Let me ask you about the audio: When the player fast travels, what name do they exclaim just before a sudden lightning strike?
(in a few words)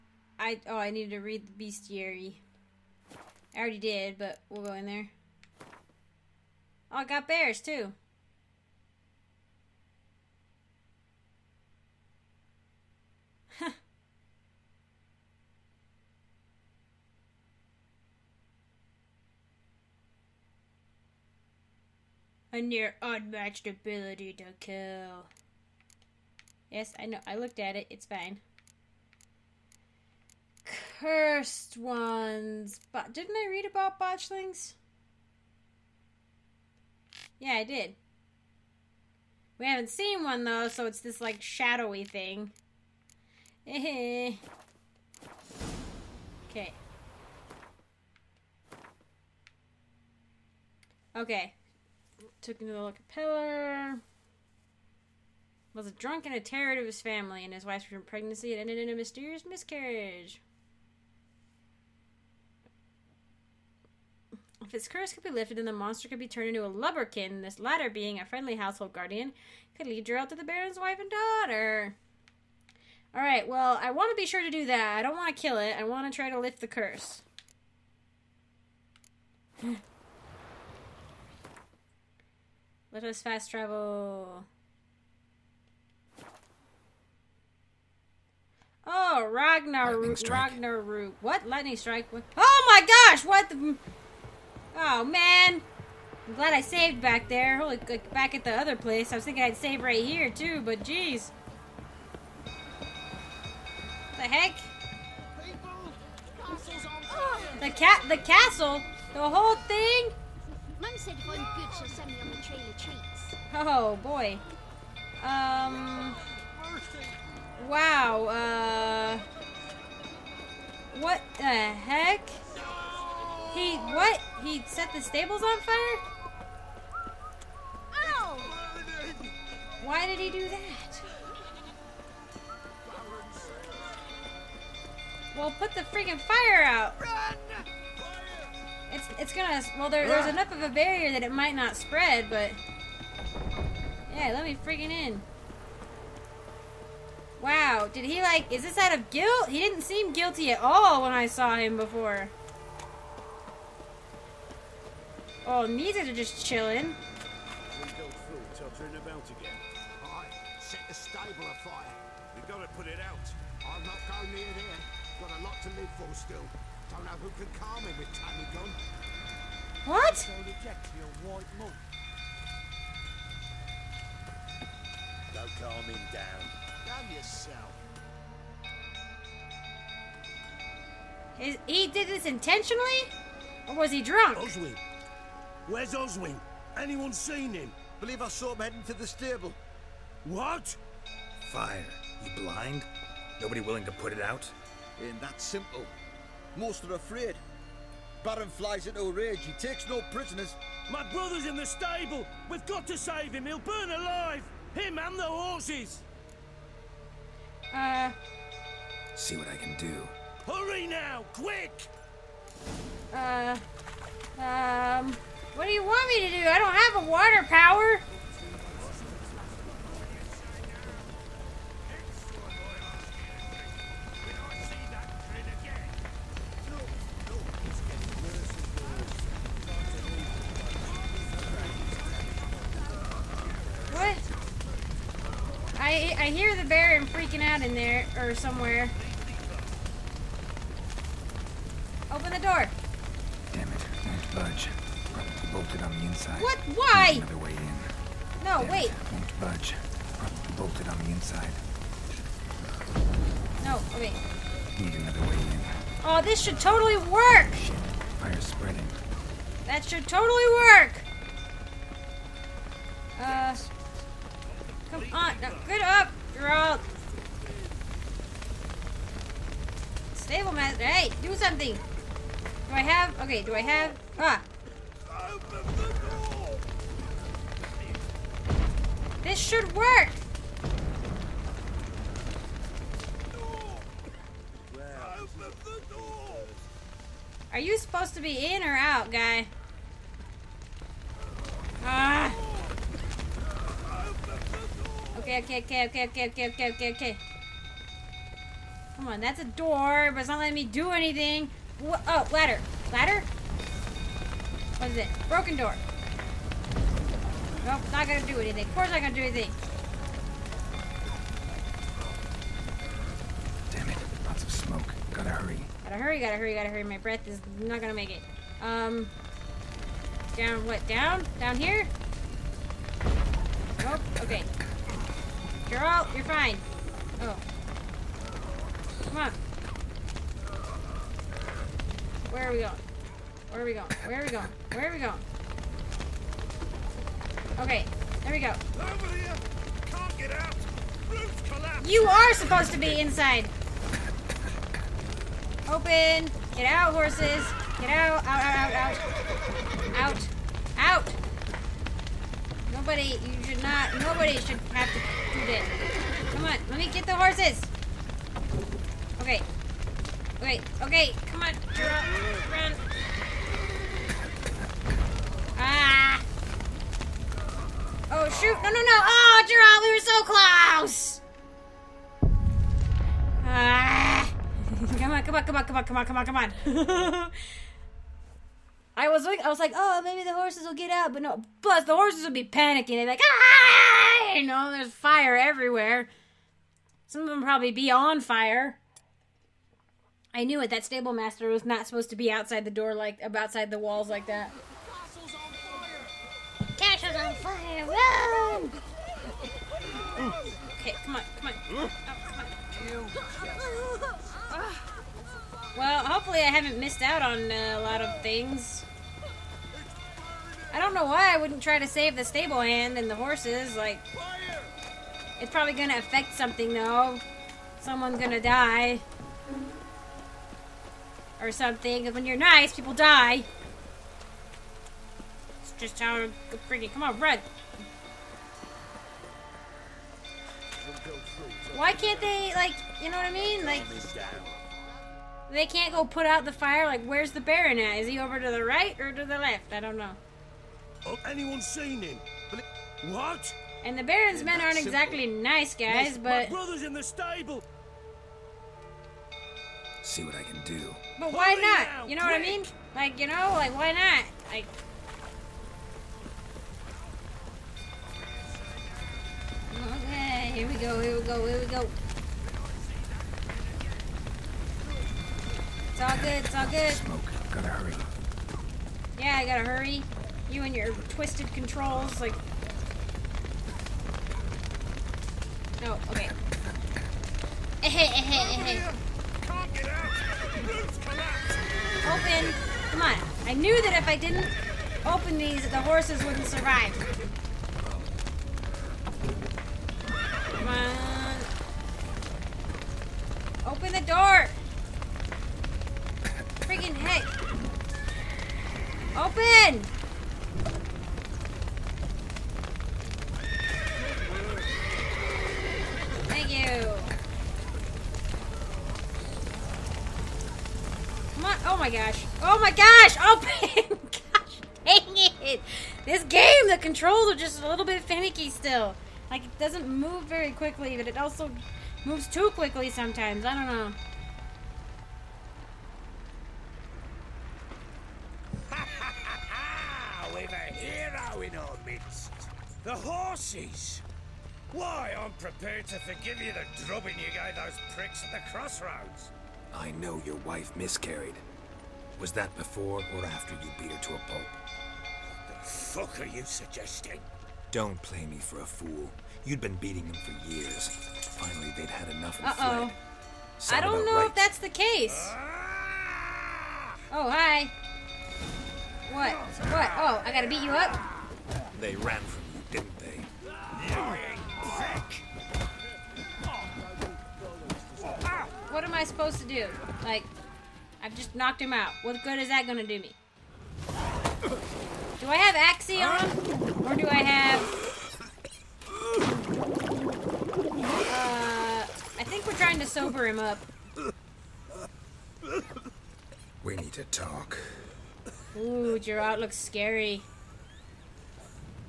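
Ragnar Ragnarok.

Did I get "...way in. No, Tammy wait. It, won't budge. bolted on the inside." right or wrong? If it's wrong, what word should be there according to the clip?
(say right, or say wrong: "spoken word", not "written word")
wrong: "Damn", not "Tammy".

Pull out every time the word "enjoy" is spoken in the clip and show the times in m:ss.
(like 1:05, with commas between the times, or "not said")
not said.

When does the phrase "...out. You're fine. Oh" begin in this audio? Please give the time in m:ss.
5:25.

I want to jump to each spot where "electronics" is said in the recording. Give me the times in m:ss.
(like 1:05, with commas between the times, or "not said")
not said.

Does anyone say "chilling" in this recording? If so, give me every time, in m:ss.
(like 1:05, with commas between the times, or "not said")
2:36.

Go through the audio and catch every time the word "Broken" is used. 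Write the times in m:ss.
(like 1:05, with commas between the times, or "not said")
5:05.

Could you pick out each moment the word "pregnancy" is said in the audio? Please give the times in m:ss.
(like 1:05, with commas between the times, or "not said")
0:58.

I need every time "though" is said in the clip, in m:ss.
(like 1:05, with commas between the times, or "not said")
0:40, 6:56.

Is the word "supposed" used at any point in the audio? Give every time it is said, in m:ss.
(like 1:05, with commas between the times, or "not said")
4:47, 5:42, 6:31, 9:29.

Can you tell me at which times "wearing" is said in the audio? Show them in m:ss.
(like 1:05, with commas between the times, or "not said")
not said.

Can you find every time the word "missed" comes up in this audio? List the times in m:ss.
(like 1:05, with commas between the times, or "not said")
6:46.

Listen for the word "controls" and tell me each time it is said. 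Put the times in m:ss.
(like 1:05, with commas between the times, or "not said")
7:51, 8:36.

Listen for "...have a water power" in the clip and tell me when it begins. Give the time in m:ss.
3:36.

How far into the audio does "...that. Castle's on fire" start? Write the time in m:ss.
6:34.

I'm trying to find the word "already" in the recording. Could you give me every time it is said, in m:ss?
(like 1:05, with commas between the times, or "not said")
0:03.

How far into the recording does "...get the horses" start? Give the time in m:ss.
5:56.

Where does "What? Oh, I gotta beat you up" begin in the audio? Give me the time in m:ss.
9:19.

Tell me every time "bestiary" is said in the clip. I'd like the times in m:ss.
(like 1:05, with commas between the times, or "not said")
0:01.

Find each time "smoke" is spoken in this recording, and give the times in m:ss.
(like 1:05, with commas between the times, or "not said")
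5:14, 7:46.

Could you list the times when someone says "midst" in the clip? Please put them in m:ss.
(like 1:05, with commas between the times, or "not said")
8:51.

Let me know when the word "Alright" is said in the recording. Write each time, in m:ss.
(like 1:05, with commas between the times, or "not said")
1:13.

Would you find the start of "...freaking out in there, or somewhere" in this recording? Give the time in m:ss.
3:57.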